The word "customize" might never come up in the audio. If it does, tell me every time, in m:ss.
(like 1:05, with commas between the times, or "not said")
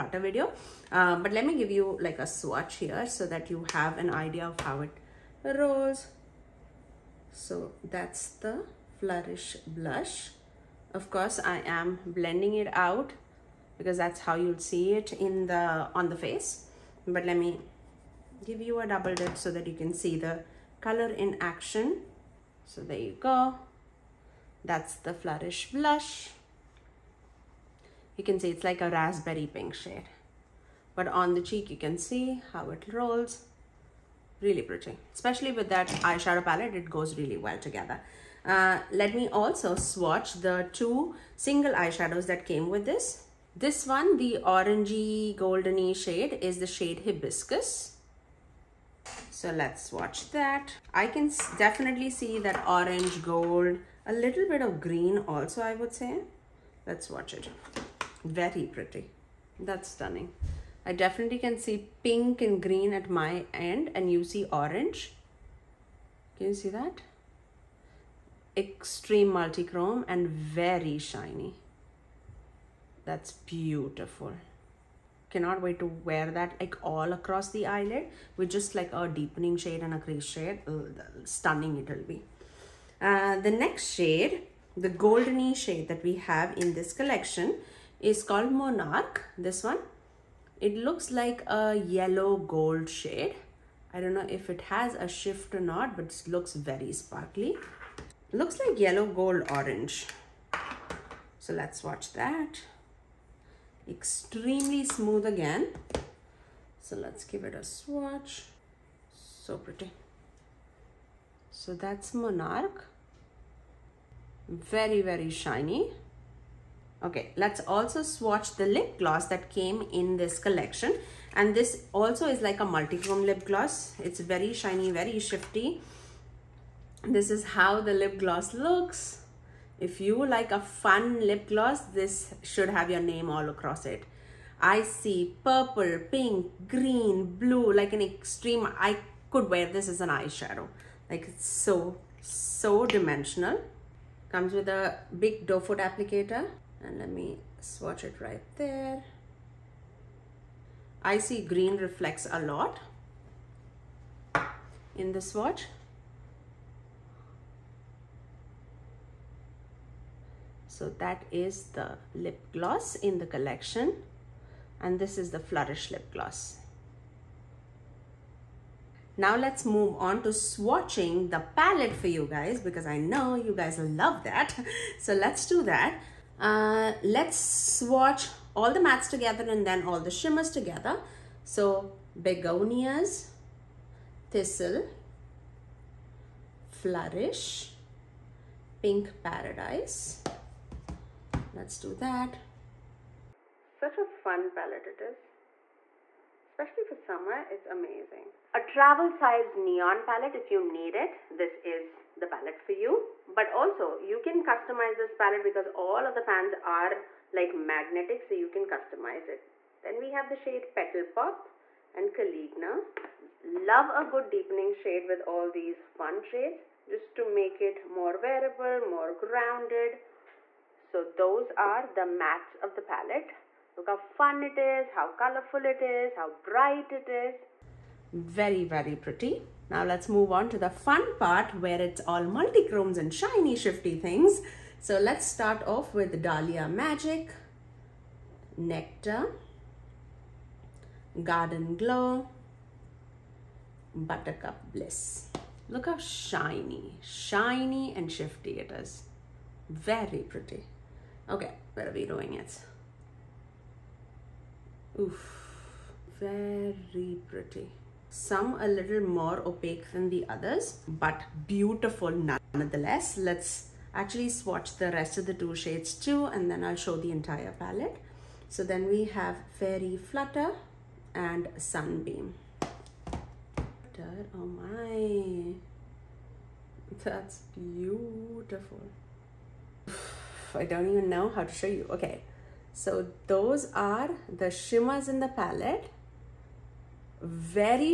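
3:24, 3:28.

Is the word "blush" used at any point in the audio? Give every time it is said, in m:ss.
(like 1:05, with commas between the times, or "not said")
0:09, 0:25.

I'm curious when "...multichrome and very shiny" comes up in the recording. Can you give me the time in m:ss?
1:09.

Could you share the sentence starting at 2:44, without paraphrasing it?
And this is the Flourish lip gloss.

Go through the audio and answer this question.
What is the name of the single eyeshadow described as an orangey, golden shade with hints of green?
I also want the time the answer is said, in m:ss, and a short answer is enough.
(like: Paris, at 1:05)
Hibiscus, at 0:47.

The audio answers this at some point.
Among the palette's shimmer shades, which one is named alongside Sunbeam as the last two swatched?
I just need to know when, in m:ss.
4:29.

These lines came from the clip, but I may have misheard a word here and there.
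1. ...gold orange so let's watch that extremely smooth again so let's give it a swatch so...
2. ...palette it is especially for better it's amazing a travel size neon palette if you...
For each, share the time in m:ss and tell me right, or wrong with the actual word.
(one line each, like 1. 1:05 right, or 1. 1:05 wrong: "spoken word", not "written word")
1. 1:39 right
2. 3:14 wrong: "summer", not "better".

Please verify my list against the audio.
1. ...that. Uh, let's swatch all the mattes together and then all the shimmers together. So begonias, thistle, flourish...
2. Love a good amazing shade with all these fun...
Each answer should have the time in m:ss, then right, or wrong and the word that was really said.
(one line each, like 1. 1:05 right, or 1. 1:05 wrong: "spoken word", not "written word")
1. 2:55 right
2. 3:33 wrong: "deepening", not "amazing".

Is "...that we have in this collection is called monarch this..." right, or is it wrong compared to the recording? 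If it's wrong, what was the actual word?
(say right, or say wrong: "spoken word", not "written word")
right.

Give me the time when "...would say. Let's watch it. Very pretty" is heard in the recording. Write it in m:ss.
0:55.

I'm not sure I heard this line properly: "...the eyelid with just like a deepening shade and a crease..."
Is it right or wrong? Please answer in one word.
right.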